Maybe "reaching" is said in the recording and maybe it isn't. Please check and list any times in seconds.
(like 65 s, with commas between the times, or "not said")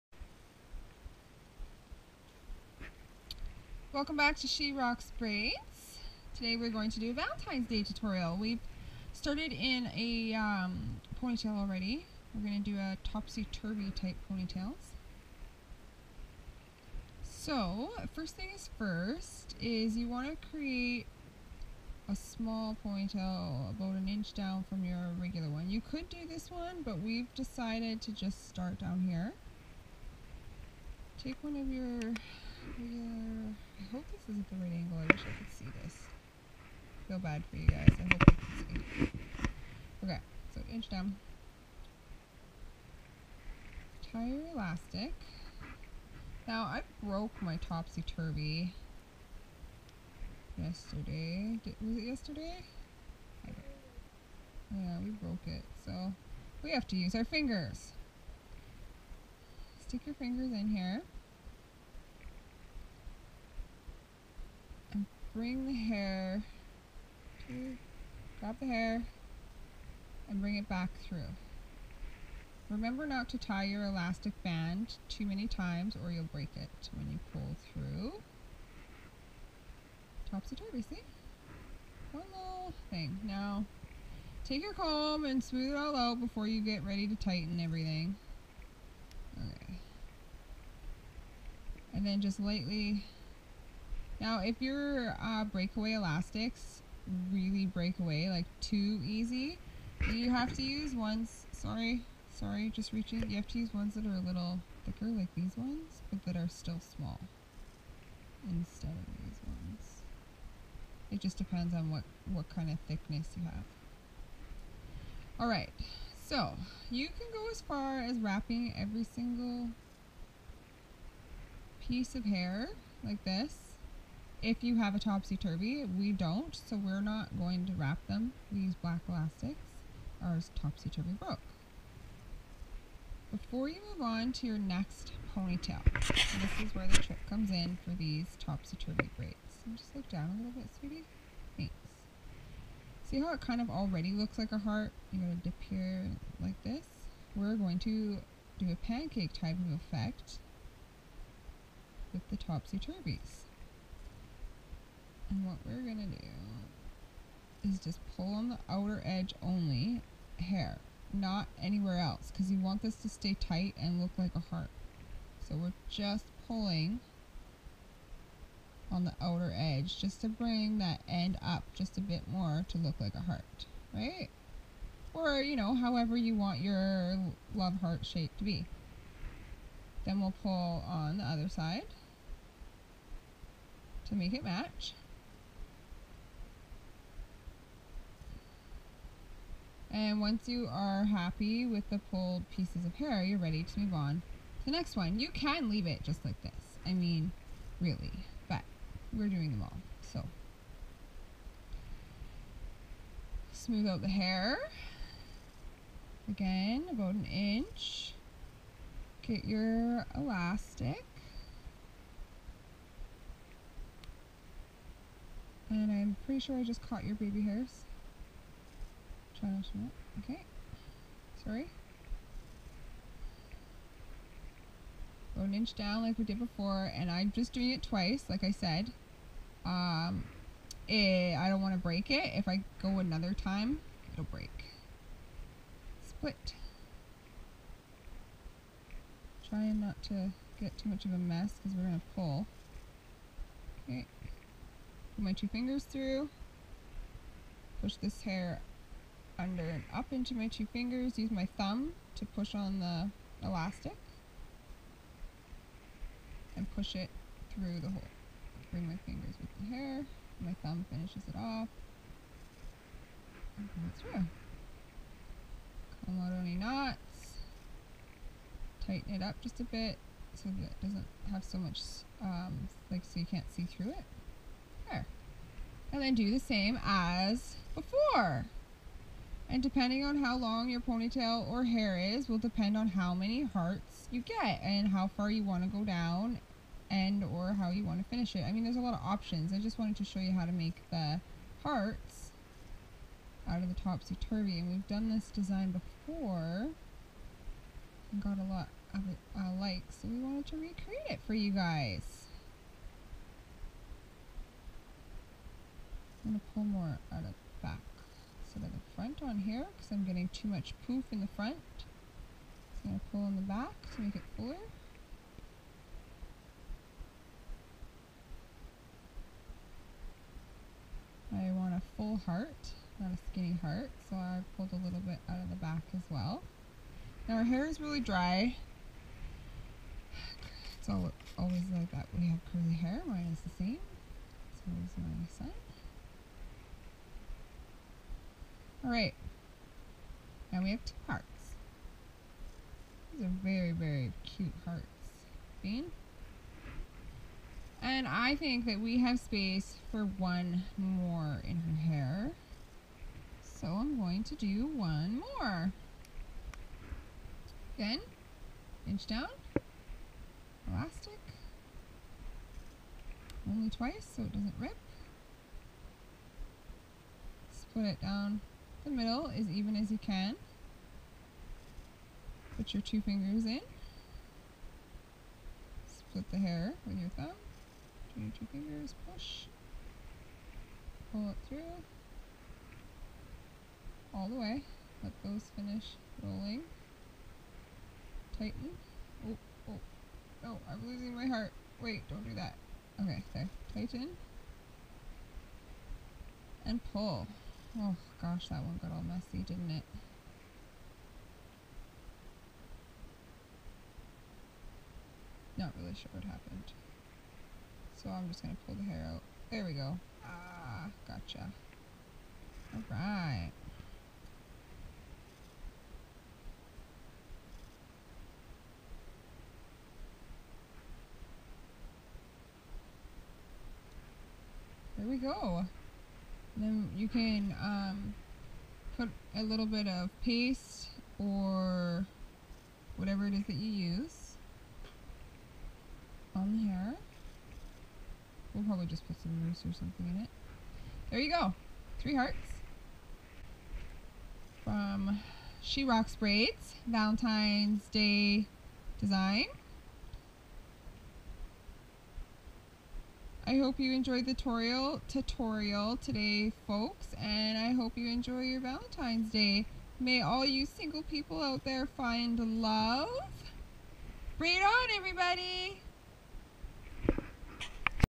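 102 s.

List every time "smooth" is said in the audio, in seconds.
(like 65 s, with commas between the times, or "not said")
85 s, 203 s.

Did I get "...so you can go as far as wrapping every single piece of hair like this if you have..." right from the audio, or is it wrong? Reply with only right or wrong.
right.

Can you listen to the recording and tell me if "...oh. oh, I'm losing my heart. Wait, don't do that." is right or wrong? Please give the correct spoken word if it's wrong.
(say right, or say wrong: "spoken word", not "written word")
right.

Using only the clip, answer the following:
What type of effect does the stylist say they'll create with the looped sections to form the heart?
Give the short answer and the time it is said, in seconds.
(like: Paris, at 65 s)
pancake, at 148 s.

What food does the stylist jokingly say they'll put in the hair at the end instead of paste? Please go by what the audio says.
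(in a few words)
rice.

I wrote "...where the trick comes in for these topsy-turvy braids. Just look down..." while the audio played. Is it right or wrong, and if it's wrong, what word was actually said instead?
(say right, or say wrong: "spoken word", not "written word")
right.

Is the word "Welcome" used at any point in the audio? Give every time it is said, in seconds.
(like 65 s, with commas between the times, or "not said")
3 s.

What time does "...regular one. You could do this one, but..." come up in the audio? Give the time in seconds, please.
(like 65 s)
25 s.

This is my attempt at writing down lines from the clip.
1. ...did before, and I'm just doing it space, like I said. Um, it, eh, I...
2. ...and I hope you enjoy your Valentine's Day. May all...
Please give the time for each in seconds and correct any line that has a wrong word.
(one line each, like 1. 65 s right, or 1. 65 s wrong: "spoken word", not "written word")
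1. 226 s wrong: "twice", not "space"
2. 457 s right.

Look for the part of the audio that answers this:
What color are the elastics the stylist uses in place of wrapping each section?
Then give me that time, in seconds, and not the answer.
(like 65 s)
128 s.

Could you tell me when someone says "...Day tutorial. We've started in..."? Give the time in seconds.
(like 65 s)
7 s.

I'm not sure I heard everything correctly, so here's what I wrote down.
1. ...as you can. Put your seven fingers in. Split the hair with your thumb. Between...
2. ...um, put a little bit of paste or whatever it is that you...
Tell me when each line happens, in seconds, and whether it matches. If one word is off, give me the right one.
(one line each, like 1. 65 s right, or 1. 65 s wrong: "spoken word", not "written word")
1. 369 s wrong: "two", not "seven"
2. 427 s right.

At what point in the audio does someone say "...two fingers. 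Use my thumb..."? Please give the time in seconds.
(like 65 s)
250 s.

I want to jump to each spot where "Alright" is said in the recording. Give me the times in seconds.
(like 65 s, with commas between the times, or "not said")
115 s, 338 s, 412 s.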